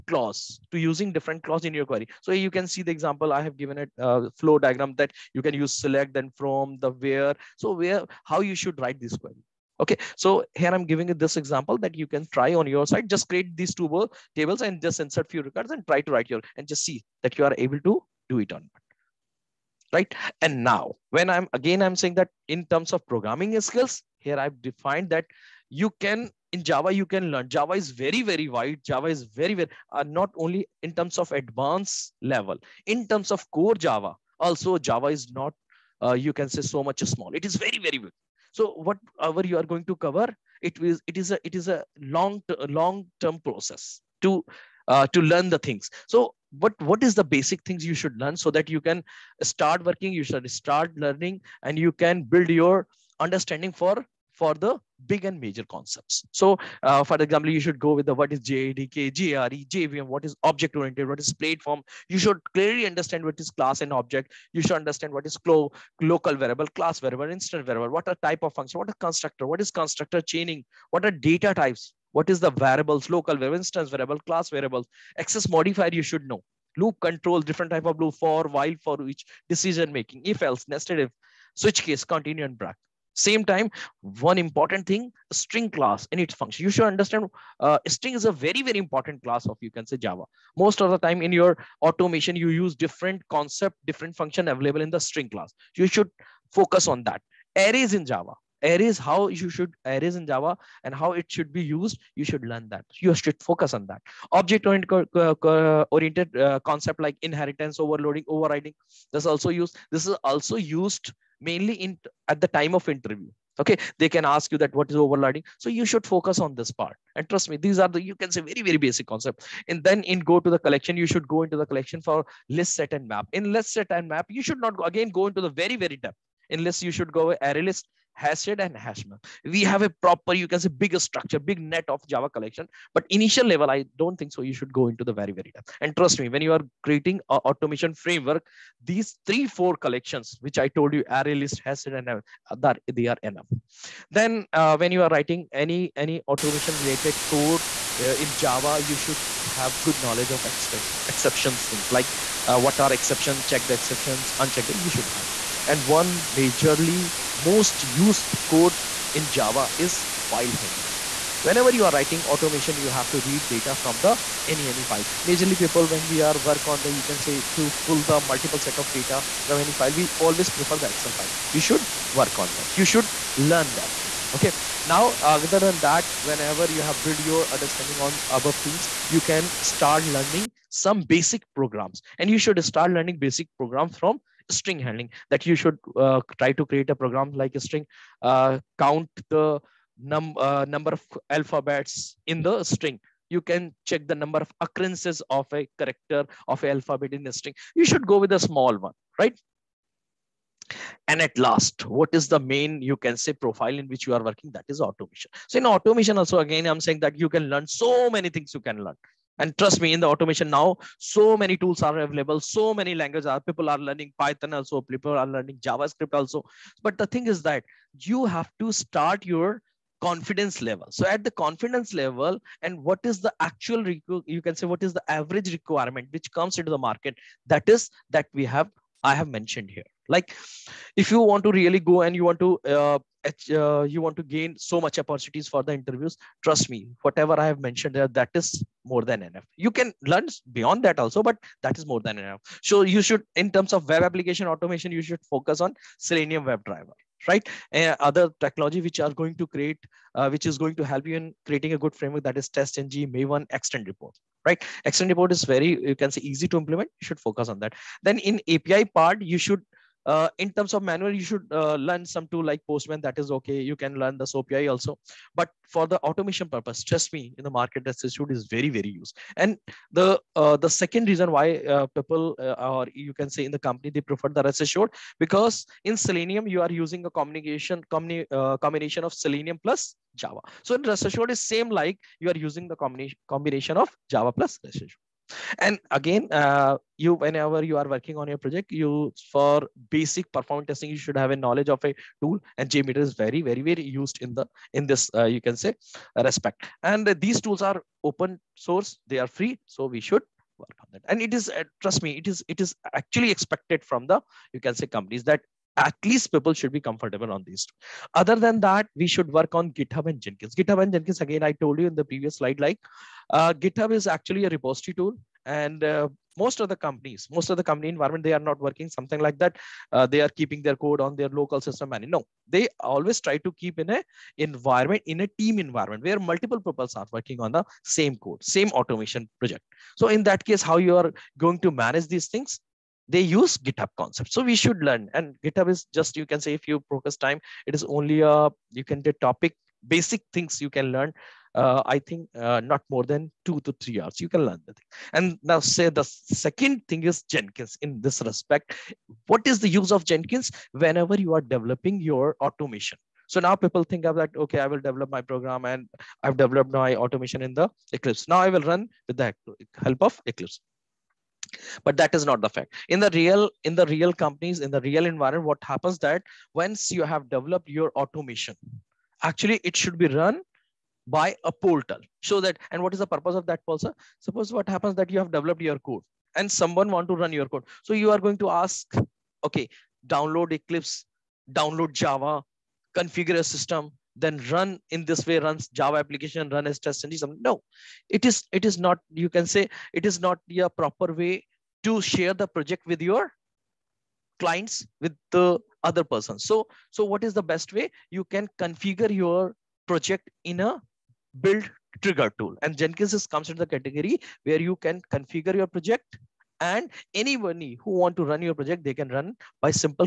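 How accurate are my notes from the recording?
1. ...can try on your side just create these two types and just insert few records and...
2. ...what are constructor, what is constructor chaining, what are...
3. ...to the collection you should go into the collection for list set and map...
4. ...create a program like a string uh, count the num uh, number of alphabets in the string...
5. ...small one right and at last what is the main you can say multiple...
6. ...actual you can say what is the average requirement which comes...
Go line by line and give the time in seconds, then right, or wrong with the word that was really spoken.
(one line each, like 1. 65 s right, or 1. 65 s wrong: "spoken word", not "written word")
1. 12 s wrong: "tables", not "types"
2. 68 s right
3. 120 s right
4. 186 s right
5. 198 s wrong: "profile", not "multiple"
6. 223 s right.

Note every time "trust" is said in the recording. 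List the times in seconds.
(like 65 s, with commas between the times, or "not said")
117 s, 135 s, 209 s, 236 s, 266 s, 301 s.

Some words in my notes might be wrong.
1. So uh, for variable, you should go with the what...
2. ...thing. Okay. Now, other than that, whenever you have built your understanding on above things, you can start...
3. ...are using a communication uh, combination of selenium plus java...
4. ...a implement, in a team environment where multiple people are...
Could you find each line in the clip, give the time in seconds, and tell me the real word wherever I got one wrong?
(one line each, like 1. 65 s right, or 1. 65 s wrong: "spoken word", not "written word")
1. 56 s wrong: "example", not "variable"
2. 174 s right
3. 276 s right
4. 323 s wrong: "environment", not "implement".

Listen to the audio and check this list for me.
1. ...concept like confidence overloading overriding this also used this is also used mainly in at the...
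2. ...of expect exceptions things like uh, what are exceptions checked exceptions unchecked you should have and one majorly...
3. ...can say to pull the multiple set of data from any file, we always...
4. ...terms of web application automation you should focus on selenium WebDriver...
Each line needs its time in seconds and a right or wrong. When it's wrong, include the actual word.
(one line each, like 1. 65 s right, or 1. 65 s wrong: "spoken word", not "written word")
1. 106 s wrong: "inheritance", not "confidence"
2. 150 s right
3. 167 s right
4. 243 s right.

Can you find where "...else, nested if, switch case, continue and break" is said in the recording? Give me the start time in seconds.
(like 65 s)
80 s.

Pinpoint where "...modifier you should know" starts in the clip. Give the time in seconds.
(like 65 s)
75 s.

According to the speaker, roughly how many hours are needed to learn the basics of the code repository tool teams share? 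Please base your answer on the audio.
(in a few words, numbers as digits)
2 to 3 hours.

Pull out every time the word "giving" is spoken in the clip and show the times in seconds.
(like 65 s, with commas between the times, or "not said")
10 s.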